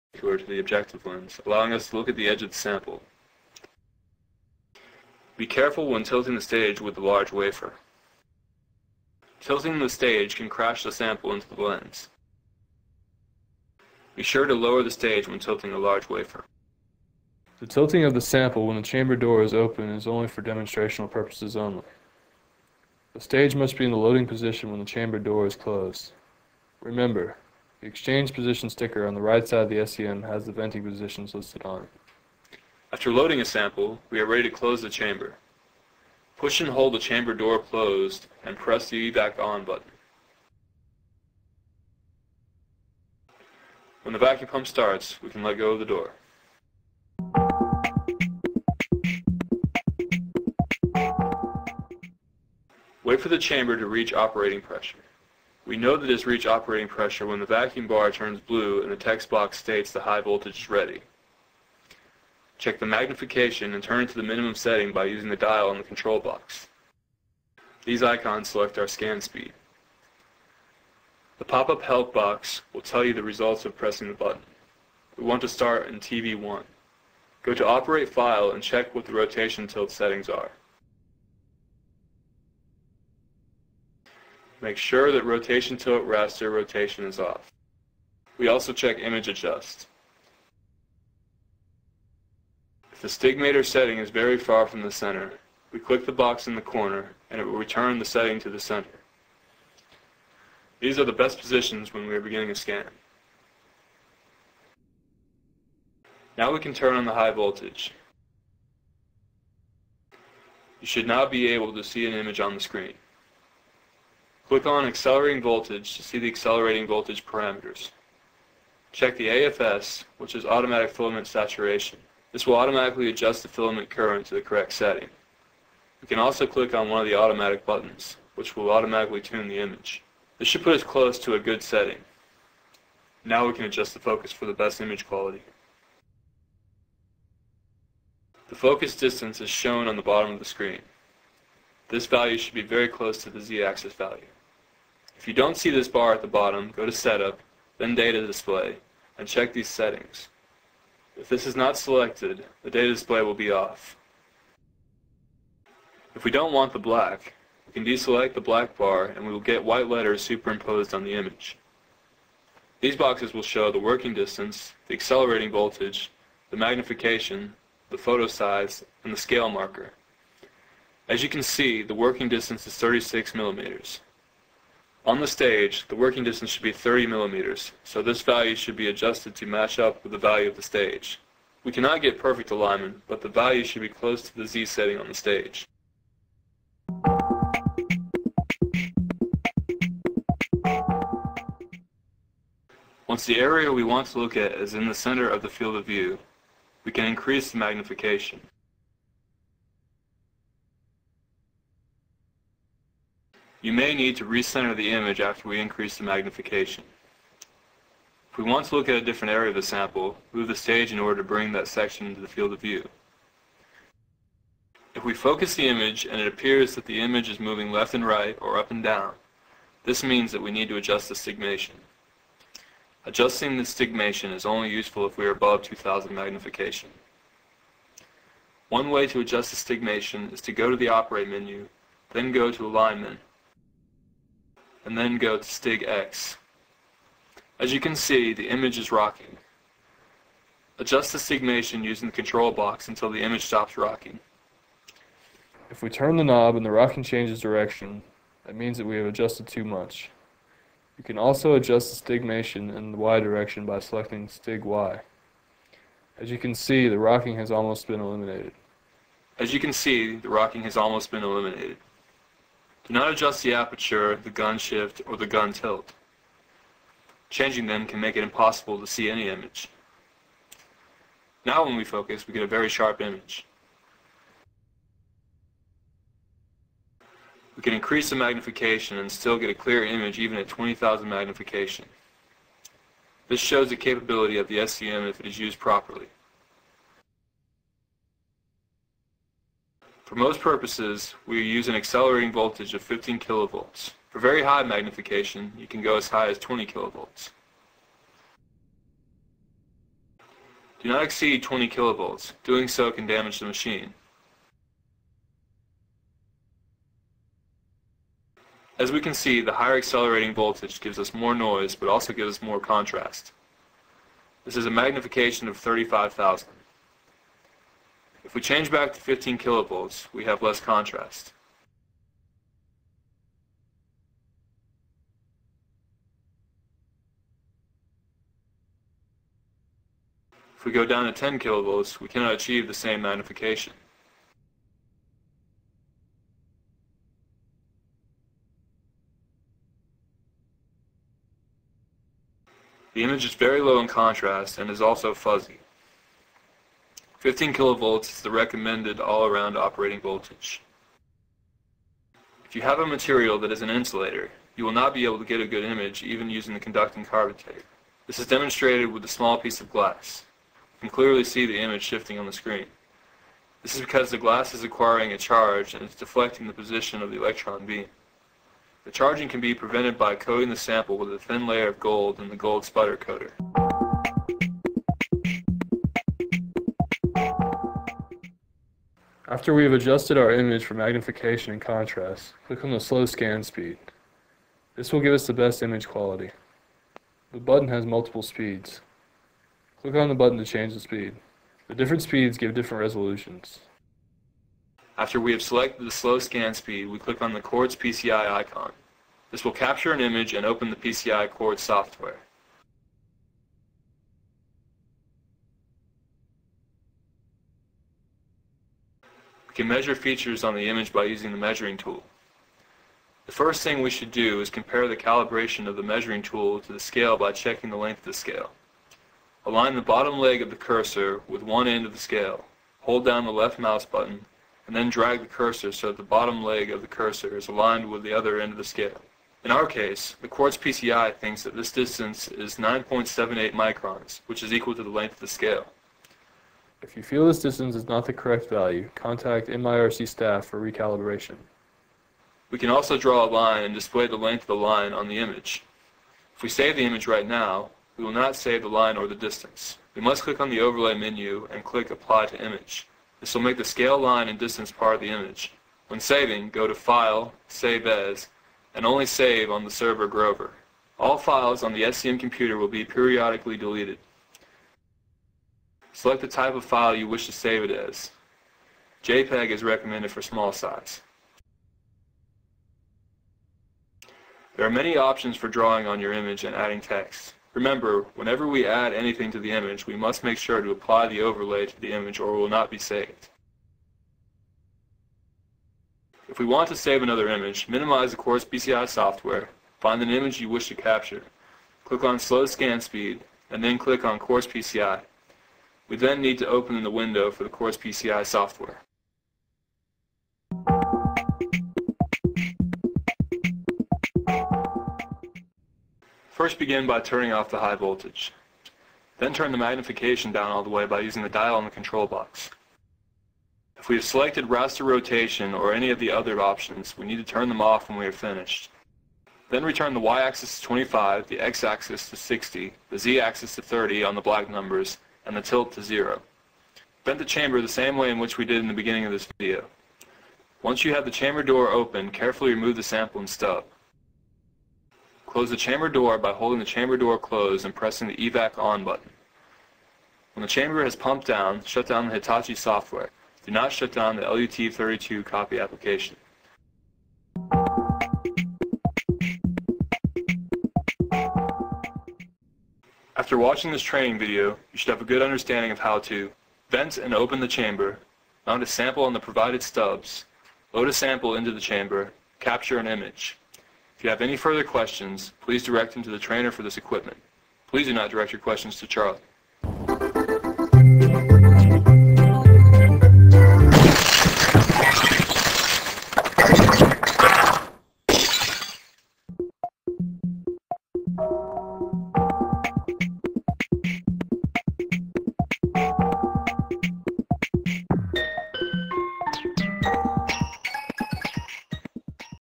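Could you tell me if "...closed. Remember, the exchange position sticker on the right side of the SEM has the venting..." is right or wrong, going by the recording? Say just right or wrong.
right.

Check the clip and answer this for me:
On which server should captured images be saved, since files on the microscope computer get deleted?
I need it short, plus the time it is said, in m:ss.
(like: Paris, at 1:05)
Grover, at 7:40.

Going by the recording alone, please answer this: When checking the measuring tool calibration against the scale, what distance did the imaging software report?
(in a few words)
9.78 microns.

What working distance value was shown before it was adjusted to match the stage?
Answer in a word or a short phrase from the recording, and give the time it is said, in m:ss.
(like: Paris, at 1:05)
36 millimeters, at 2:52.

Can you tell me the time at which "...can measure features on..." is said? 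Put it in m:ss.
6:49.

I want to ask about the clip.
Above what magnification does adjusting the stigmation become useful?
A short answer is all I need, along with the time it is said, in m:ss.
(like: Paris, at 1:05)
2000, at 3:45.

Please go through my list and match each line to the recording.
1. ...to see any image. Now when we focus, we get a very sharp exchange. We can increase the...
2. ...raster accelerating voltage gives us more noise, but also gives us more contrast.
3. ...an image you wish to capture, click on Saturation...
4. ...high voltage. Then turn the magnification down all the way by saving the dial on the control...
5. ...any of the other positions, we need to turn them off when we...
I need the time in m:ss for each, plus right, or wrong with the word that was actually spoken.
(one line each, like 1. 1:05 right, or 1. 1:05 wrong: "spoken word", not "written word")
1. 4:28 wrong: "image", not "exchange"
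2. 5:09 wrong: "higher", not "raster"
3. 8:10 wrong: "Slow", not "Saturation"
4. 8:27 wrong: "using", not "saving"
5. 8:35 wrong: "options", not "positions".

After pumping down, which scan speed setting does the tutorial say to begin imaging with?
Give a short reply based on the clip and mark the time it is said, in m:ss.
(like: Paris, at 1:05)
TV1, at 1:15.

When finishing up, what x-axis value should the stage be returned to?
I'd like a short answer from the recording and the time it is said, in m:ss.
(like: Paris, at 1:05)
60, at 8:42.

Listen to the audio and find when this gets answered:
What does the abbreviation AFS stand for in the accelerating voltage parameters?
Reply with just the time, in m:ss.
2:00.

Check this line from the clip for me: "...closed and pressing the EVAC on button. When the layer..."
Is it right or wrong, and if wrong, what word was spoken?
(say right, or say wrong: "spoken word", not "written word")
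wrong: "chamber", not "layer".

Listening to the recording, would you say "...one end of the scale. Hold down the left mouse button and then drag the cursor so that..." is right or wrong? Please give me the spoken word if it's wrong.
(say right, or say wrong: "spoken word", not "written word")
right.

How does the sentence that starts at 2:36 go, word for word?
If we don't want the black, we can deselect the black bar and we will get white letters superimposed on the image.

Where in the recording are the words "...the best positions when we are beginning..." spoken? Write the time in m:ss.
1:41.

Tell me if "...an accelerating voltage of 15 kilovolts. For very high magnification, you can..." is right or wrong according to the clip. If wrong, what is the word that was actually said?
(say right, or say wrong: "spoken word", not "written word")
right.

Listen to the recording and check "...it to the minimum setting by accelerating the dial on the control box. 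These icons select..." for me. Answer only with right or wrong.
wrong.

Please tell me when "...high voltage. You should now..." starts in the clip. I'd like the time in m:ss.
1:47.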